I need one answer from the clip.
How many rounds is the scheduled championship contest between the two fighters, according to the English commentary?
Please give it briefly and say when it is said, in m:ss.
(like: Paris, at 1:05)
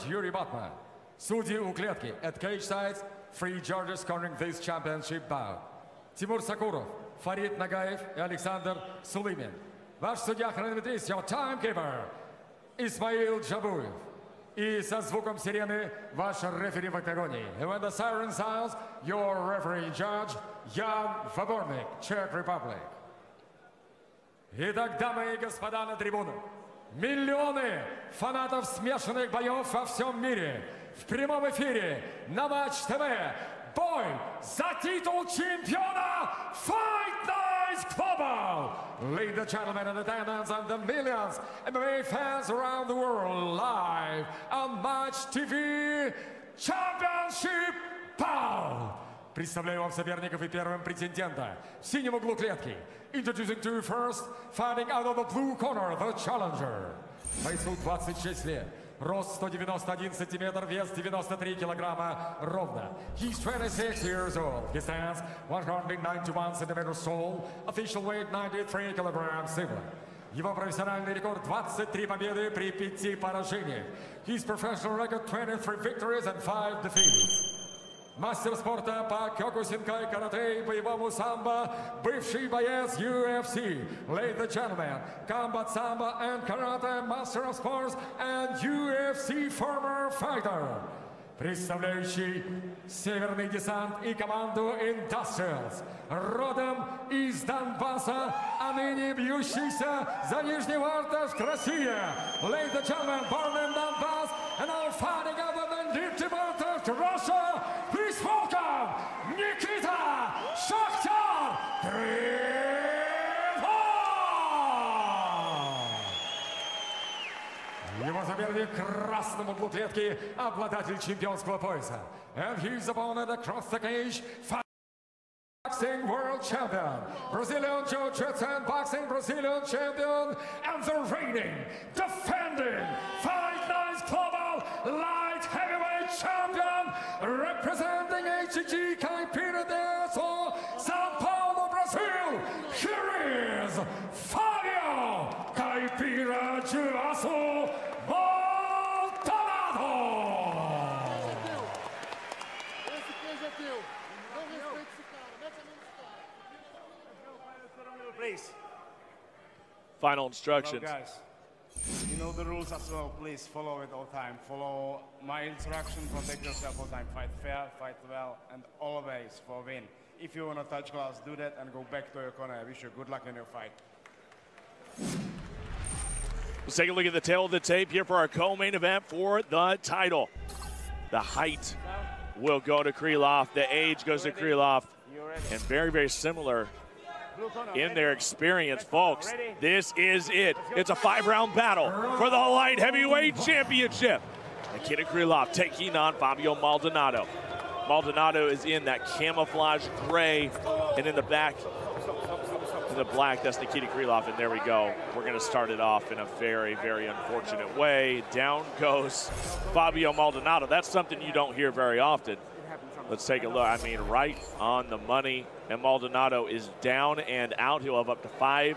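5, at 3:10.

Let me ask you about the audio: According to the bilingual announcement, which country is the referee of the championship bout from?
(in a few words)
Czech Republic.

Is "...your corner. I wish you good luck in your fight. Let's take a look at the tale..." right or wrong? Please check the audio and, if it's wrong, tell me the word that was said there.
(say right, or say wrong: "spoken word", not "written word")
right.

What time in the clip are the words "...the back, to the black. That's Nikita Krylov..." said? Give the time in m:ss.
3:21.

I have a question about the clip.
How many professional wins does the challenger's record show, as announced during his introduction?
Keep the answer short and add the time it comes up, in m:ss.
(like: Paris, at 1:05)
23, at 1:11.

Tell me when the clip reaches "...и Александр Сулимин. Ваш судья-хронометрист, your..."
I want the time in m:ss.
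0:08.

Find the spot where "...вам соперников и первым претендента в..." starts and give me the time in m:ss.
0:49.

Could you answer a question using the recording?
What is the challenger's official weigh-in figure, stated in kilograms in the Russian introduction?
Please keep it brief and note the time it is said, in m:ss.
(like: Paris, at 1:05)
93 kilograms, at 1:00.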